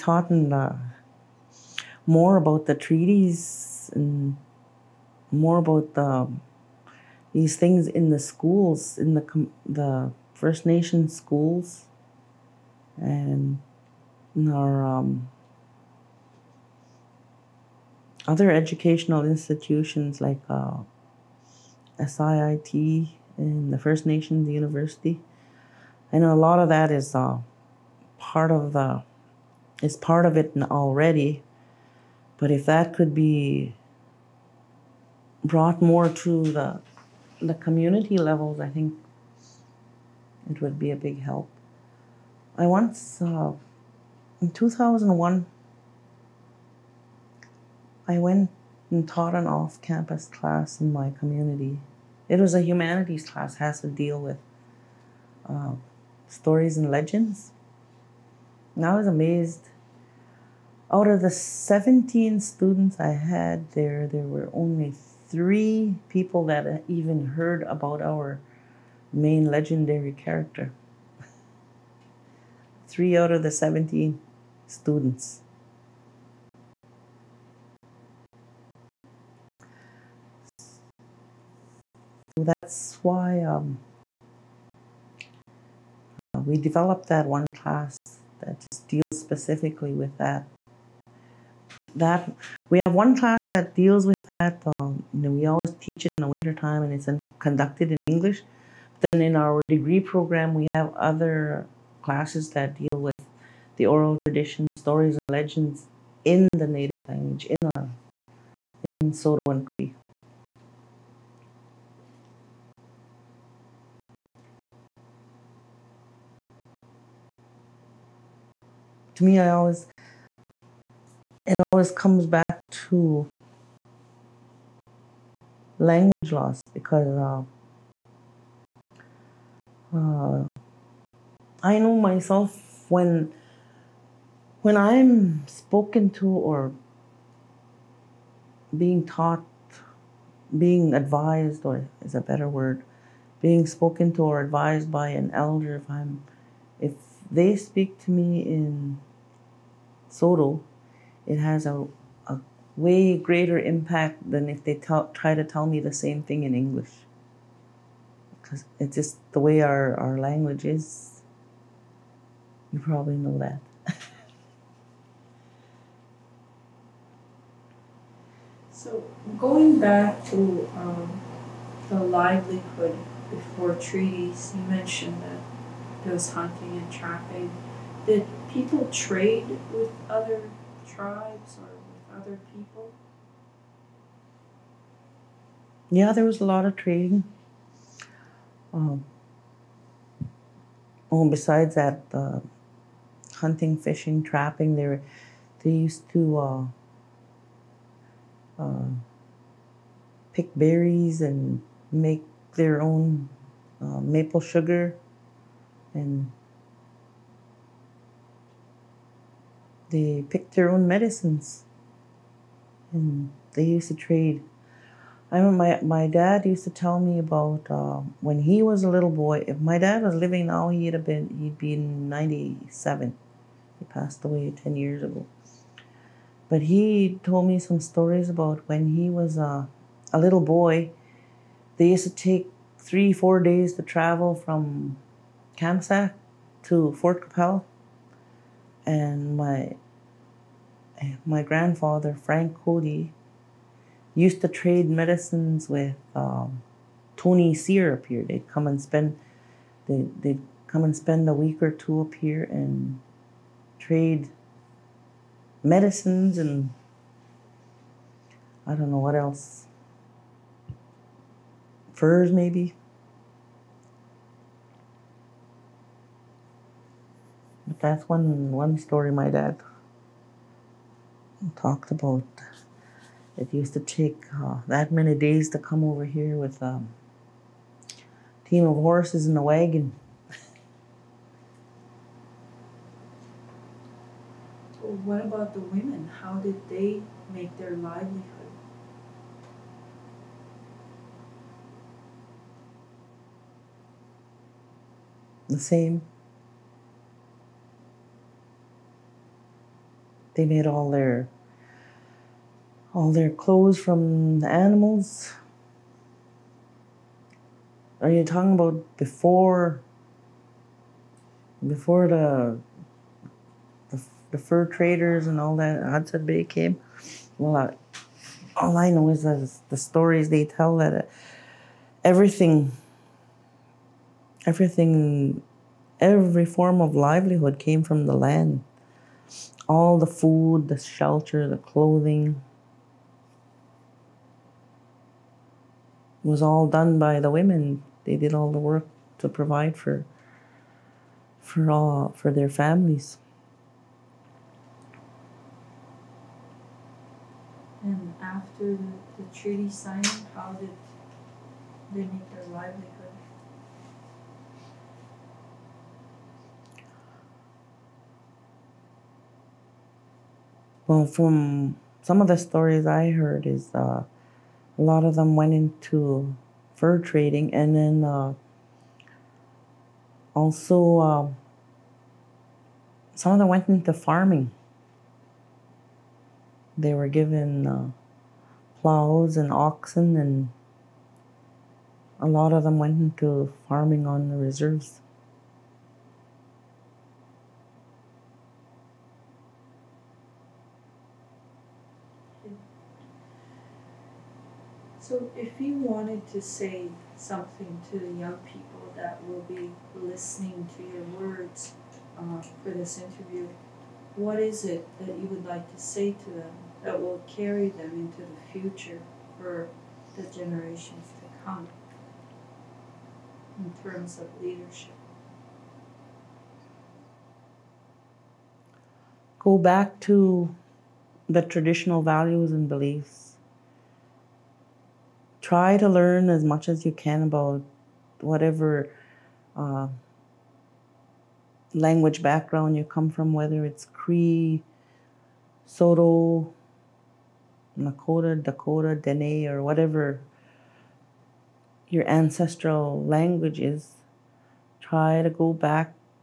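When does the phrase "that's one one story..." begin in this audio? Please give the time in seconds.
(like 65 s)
267 s.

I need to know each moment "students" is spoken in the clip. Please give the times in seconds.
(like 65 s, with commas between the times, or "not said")
62 s, 74 s.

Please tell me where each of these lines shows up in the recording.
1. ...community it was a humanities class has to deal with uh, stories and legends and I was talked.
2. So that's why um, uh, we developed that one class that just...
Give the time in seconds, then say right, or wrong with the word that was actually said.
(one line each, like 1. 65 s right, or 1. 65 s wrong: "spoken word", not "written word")
1. 51 s wrong: "amazed", not "talked"
2. 82 s right.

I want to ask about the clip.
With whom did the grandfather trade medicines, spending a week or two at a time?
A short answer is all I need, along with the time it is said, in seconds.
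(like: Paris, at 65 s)
Tony Sear, at 247 s.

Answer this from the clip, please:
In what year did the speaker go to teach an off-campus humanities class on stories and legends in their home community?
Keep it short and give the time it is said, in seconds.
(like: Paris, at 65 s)
2001, at 44 s.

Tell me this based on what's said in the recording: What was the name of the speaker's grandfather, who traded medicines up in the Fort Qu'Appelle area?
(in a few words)
Frank Cote.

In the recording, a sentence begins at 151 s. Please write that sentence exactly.
It has a, a way greater impact than if they talk, try to tell me the same thing in English.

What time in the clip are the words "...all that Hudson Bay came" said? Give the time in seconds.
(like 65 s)
315 s.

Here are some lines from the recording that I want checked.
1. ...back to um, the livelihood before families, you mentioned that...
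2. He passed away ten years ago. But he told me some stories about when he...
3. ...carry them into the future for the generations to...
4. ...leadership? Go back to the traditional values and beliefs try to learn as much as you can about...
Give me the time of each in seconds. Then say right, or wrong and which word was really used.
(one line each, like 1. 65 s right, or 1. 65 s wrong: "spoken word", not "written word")
1. 169 s wrong: "treaties", not "families"
2. 223 s right
3. 407 s right
4. 414 s right.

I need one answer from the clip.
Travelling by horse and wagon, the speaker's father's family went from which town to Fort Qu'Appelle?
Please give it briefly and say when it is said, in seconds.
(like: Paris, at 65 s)
Kamsack, at 235 s.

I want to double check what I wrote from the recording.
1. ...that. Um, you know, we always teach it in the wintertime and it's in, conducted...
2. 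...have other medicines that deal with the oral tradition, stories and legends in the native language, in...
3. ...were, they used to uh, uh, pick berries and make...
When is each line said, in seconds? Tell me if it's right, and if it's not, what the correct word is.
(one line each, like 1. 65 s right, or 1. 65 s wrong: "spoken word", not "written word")
1. 94 s right
2. 100 s wrong: "classes", not "medicines"
3. 194 s right.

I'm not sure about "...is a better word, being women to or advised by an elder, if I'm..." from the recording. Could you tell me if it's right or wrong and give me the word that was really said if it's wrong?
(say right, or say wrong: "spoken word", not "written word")
wrong: "spoken", not "women".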